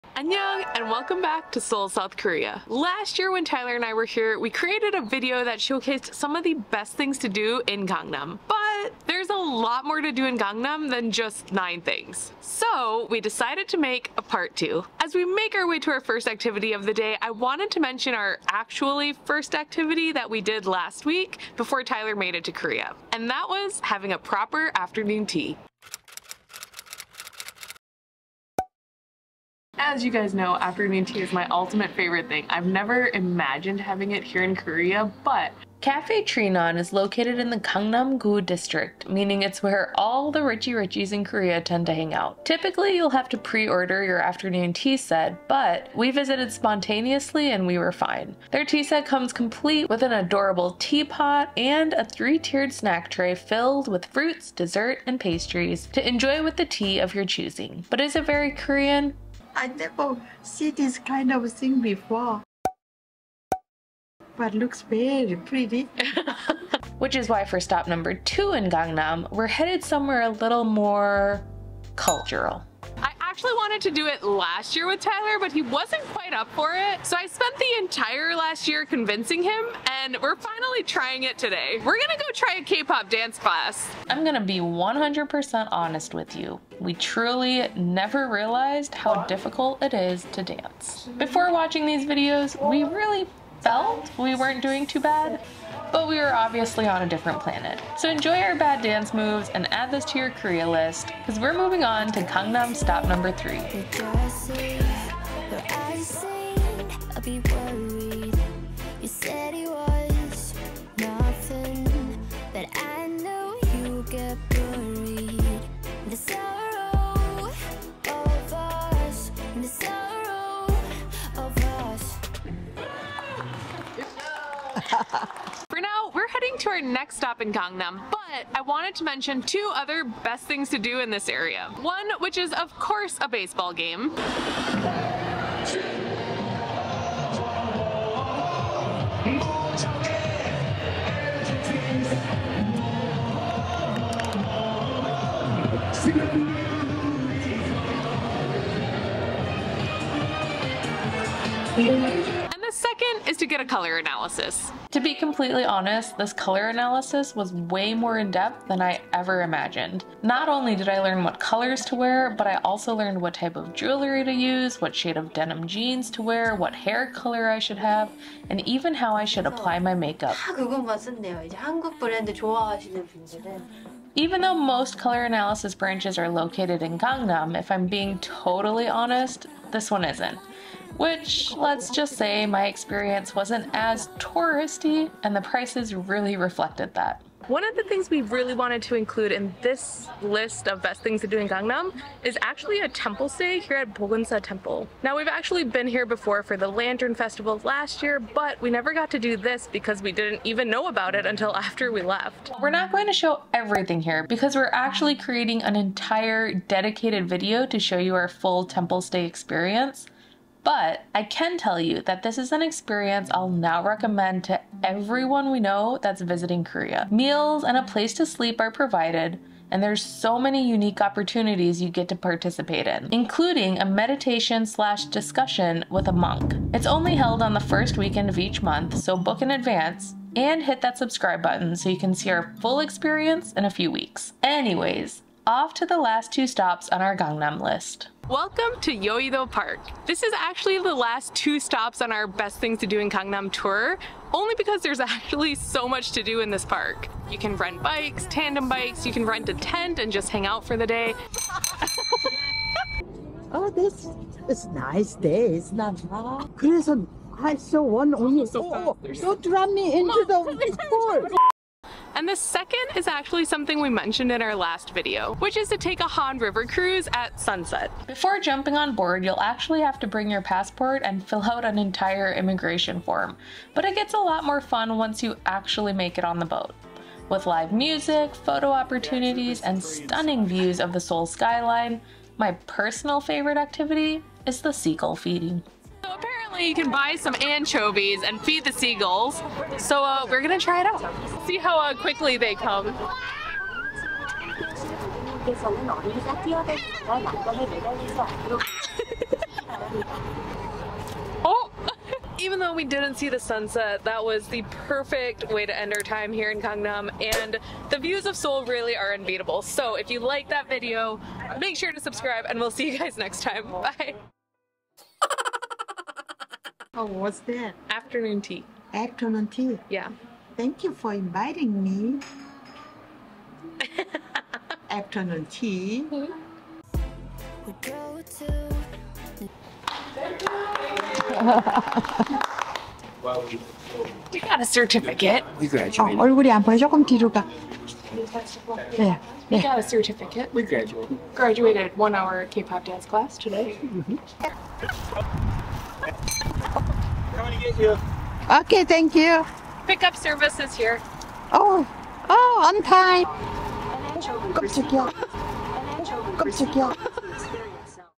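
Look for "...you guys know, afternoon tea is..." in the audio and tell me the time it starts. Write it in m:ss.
0:30.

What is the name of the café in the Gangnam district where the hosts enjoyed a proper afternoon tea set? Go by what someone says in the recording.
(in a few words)
Cafe Trinon.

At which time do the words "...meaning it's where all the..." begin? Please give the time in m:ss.
0:39.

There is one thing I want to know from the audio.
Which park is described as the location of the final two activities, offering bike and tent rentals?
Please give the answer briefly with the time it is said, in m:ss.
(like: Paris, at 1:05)
Yeouido Park, at 3:58.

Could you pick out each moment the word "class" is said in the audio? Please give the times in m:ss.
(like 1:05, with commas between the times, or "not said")
1:23, 5:43.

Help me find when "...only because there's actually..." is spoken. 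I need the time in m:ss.
4:04.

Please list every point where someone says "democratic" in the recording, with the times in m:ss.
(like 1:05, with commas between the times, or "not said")
not said.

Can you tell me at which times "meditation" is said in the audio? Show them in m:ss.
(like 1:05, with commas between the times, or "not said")
3:43.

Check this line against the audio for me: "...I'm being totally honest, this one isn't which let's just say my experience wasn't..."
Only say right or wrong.
right.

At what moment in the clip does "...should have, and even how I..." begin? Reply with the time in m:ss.
2:47.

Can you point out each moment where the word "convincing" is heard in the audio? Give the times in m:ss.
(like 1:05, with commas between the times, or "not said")
1:18.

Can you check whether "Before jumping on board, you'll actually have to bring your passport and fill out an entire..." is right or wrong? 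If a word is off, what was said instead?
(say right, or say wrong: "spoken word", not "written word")
right.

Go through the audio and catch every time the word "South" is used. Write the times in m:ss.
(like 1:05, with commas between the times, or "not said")
0:01.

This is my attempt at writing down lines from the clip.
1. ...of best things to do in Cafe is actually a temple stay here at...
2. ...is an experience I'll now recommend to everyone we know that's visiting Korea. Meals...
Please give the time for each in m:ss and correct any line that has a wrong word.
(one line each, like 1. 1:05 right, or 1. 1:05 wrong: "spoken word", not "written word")
1. 3:10 wrong: "Gangnam", not "Cafe"
2. 3:32 right.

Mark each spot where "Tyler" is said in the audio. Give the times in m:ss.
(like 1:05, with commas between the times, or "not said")
0:03, 0:21, 1:14.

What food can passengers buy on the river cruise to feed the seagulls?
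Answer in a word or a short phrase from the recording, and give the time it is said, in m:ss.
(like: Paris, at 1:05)
Anchovies, at 4:47.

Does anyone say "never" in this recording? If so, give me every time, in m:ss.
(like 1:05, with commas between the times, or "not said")
0:32, 0:59, 1:27, 3:18.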